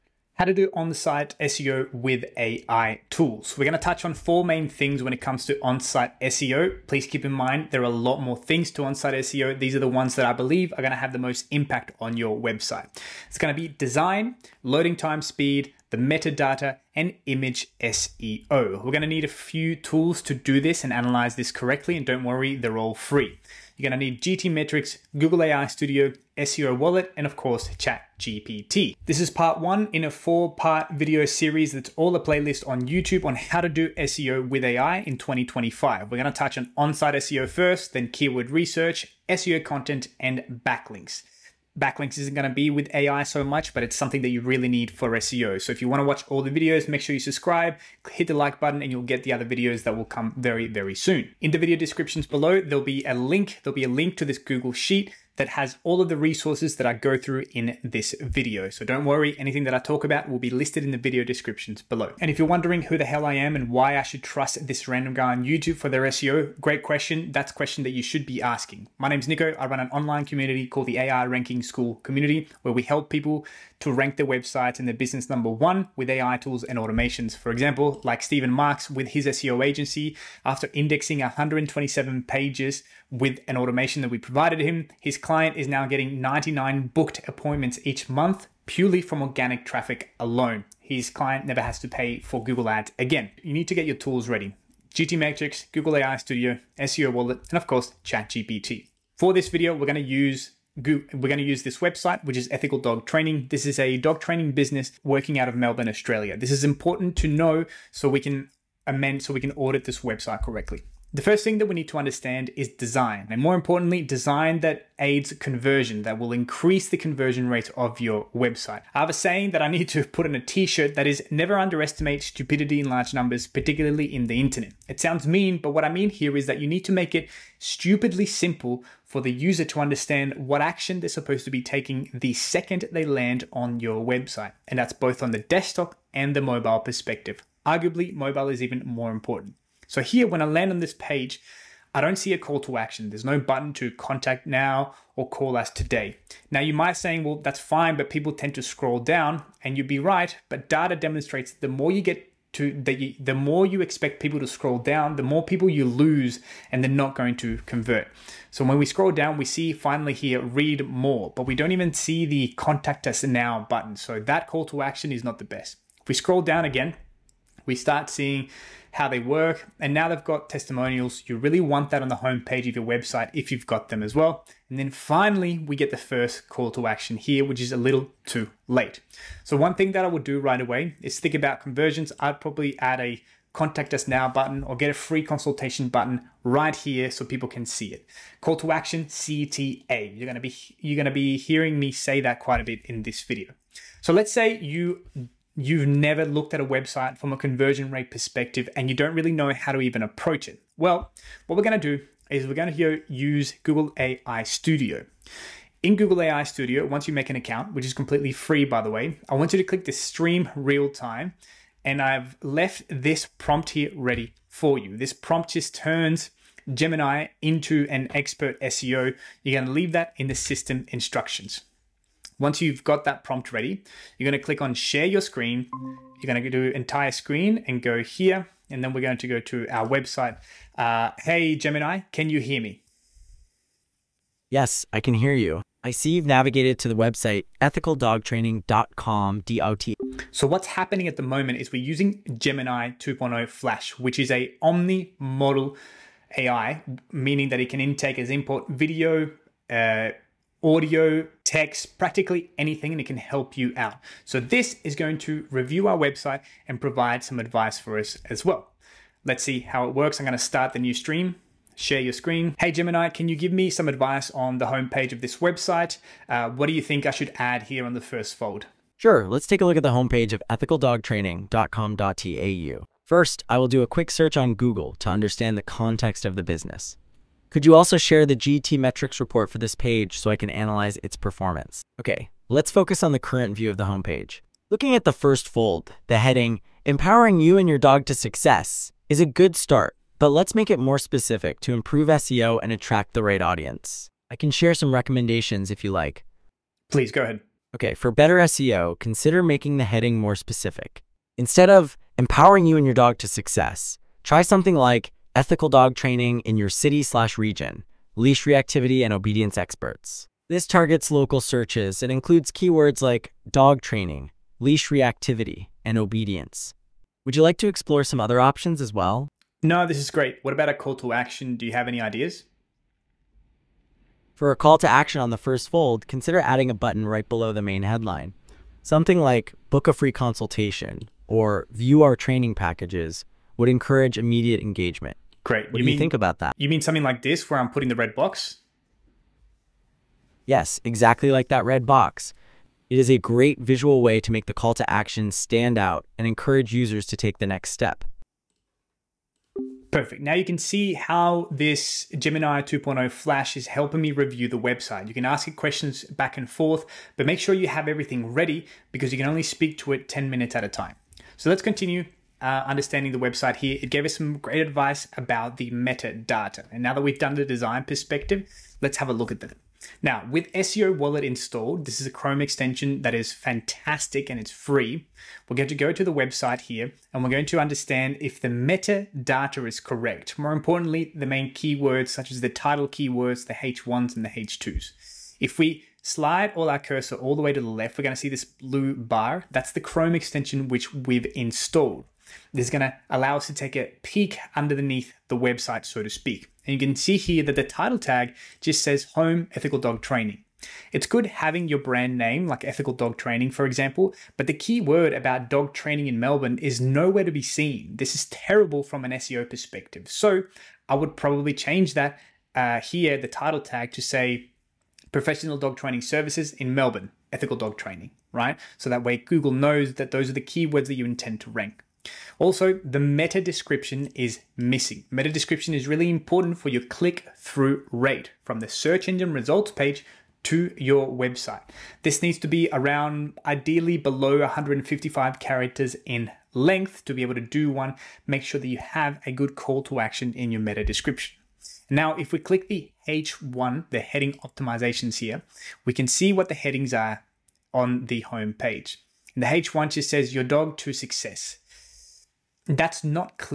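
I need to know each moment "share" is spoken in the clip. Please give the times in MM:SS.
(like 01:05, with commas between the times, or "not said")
03:44, 04:21, 04:37, 04:54.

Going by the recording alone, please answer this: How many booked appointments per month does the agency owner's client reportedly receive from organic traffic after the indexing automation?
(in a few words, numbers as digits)
99.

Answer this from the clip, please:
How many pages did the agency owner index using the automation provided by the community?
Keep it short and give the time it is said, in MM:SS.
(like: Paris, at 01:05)
127, at 01:21.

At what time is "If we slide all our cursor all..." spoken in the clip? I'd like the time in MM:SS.
06:25.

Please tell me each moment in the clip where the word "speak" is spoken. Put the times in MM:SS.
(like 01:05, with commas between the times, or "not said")
05:59, 06:36.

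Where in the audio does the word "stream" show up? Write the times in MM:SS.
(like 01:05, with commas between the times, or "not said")
03:29, 04:20.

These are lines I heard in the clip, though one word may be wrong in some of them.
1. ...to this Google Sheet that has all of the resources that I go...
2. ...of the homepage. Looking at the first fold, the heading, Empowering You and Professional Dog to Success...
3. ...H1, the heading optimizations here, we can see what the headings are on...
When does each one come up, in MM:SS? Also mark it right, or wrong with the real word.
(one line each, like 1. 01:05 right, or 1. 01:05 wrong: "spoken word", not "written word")
1. 00:54 right
2. 04:43 wrong: "Your", not "Professional"
3. 07:23 right.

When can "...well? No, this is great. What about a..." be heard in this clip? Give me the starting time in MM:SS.
05:18.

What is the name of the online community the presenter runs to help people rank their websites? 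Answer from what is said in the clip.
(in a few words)
AI Ranking Skool Community.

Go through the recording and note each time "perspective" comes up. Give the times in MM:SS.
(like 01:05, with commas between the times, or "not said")
02:16, 03:18, 06:07, 06:49.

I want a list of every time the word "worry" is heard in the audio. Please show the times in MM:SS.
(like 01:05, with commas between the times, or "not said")
00:22, 00:59.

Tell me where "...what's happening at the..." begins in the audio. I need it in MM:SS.
04:00.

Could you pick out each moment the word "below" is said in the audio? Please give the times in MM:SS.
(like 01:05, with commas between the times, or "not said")
00:52, 01:01, 05:27, 07:13.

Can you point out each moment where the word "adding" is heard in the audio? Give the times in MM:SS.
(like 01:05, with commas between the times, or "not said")
05:26.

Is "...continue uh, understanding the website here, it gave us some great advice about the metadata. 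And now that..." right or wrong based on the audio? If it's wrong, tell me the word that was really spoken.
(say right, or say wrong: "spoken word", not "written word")
right.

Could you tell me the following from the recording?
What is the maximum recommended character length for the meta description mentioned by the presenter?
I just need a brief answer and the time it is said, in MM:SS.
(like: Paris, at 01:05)
155 characters, at 07:14.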